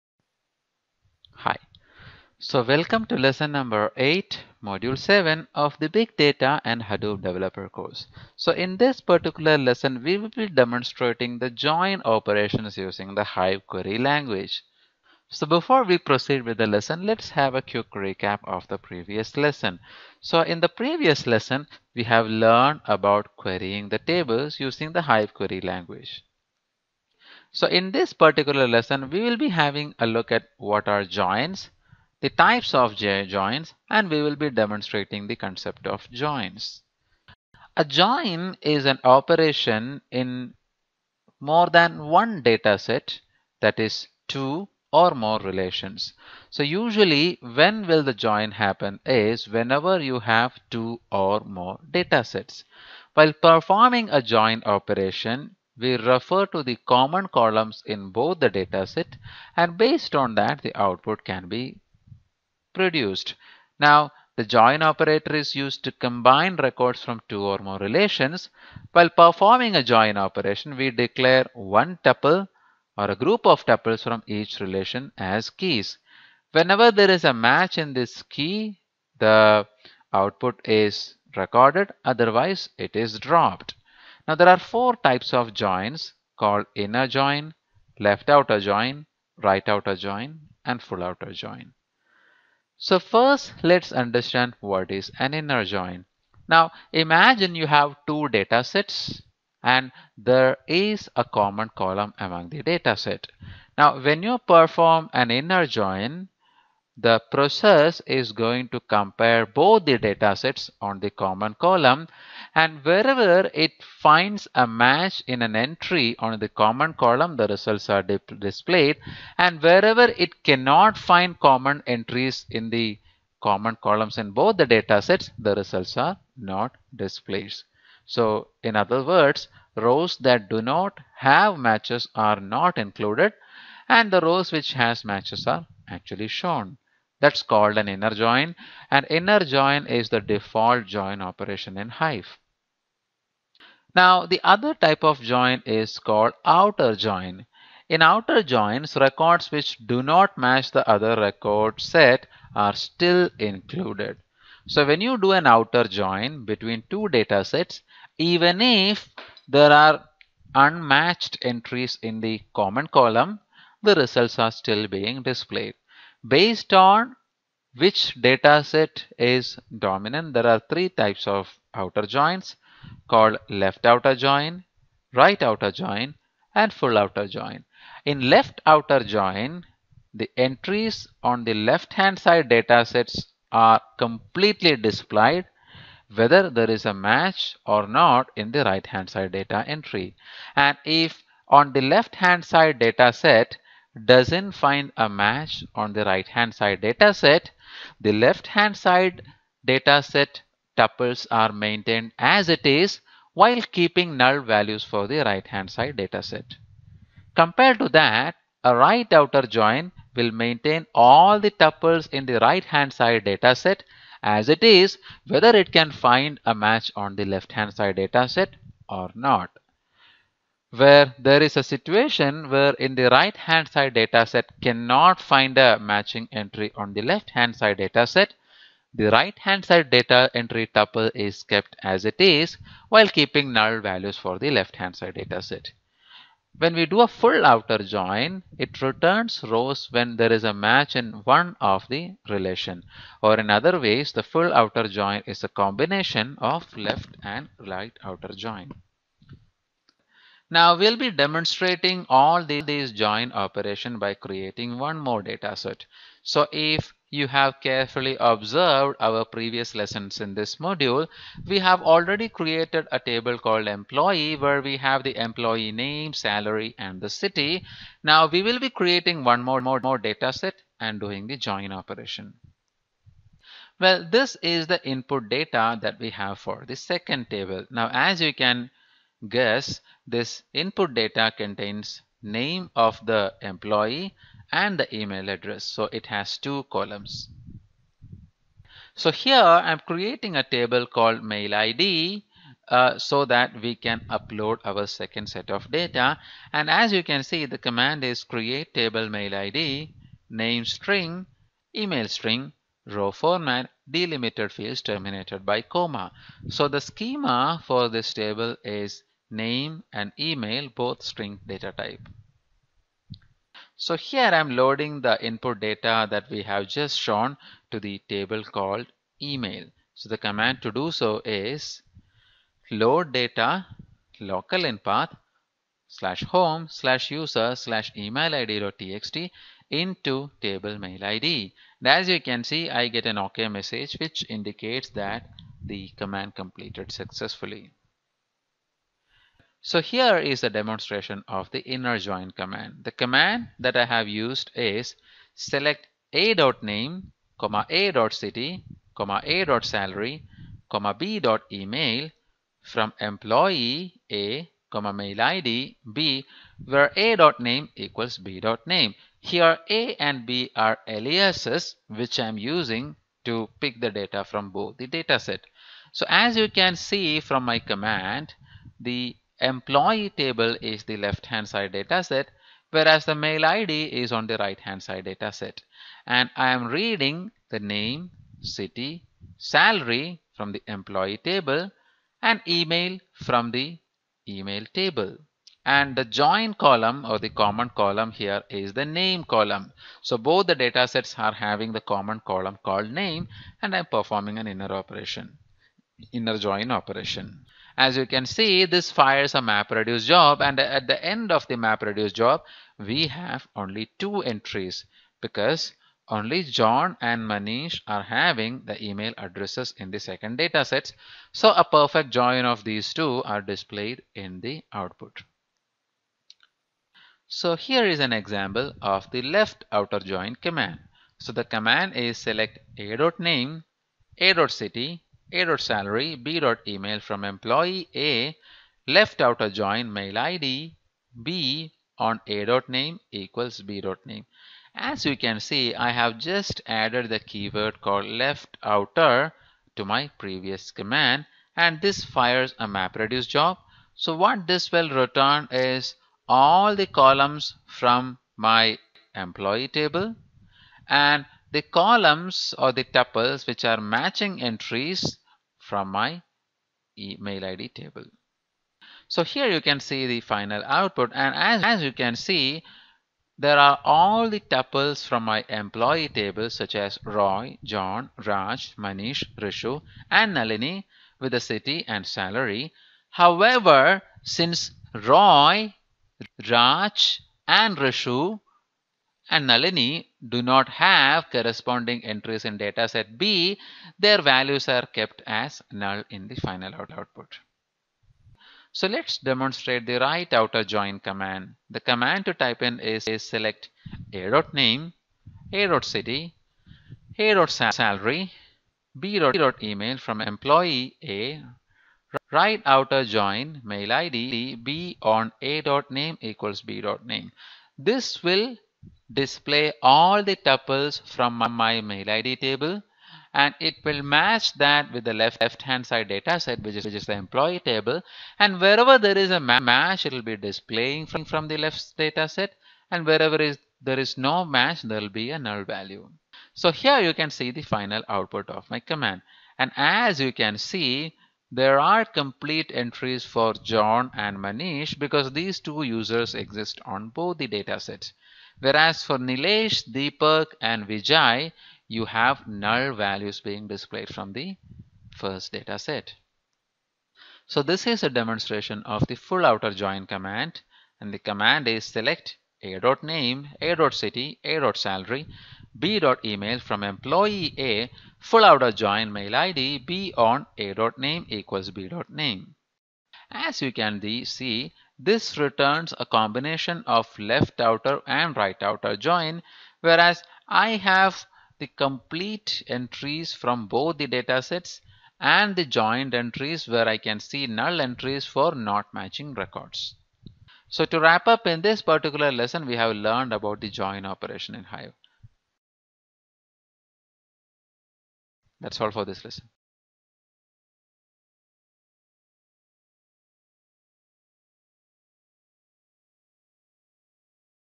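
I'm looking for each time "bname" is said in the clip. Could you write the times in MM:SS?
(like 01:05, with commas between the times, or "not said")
07:13, 08:26, 09:21.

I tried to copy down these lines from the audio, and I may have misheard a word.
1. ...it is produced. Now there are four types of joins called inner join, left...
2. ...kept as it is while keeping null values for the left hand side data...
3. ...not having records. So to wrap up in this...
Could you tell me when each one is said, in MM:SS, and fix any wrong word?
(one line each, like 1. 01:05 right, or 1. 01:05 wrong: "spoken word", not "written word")
1. 01:22 wrong: "dropped", not "produced"
2. 03:51 right
3. 09:38 wrong: "matching", not "having".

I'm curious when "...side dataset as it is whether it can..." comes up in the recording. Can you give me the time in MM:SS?
03:32.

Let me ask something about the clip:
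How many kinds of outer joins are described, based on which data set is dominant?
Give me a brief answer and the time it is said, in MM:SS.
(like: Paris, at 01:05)
3, at 02:50.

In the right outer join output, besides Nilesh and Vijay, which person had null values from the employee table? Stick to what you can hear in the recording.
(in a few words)
Deepak.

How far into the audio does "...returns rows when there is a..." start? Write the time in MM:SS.
03:58.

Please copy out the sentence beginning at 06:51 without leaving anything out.
So a perfect join of these two are displayed in the output.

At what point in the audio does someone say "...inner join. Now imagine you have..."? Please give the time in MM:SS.
01:35.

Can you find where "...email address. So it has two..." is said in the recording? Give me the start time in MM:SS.
04:44.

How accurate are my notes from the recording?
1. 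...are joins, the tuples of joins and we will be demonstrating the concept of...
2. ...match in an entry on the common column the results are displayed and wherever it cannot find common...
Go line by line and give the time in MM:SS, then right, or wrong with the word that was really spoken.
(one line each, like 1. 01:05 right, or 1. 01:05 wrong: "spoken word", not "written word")
1. 00:30 wrong: "types", not "tuples"
2. 01:54 right.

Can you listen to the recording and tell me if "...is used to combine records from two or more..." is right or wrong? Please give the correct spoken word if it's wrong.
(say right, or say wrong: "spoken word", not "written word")
right.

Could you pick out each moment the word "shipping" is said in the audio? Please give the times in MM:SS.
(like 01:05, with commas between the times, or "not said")
not said.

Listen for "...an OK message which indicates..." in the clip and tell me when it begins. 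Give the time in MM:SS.
05:33.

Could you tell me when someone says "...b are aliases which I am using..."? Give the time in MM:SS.
06:00.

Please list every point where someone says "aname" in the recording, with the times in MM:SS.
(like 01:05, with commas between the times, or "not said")
07:12, 08:14, 08:25, 09:12, 09:20.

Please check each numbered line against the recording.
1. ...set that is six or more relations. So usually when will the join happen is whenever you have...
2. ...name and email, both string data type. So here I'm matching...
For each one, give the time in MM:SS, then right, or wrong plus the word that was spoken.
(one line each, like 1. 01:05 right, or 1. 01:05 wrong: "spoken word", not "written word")
1. 00:42 wrong: "two", not "six"
2. 05:09 wrong: "loading", not "matching".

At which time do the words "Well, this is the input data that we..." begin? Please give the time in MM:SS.
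04:33.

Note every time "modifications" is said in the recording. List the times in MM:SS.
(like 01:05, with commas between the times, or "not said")
not said.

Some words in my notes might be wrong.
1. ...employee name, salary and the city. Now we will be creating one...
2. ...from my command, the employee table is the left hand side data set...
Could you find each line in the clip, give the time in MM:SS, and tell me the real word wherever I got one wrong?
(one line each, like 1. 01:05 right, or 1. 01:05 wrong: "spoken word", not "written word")
1. 04:25 right
2. 06:07 right.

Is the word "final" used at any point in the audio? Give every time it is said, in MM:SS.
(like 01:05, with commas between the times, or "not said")
07:40, 08:06, 08:47.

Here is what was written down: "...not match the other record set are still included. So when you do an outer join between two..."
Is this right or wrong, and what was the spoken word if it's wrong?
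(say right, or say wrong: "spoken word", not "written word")
right.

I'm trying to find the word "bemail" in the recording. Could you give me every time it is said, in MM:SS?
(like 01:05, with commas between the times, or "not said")
07:06, 08:18, 09:15.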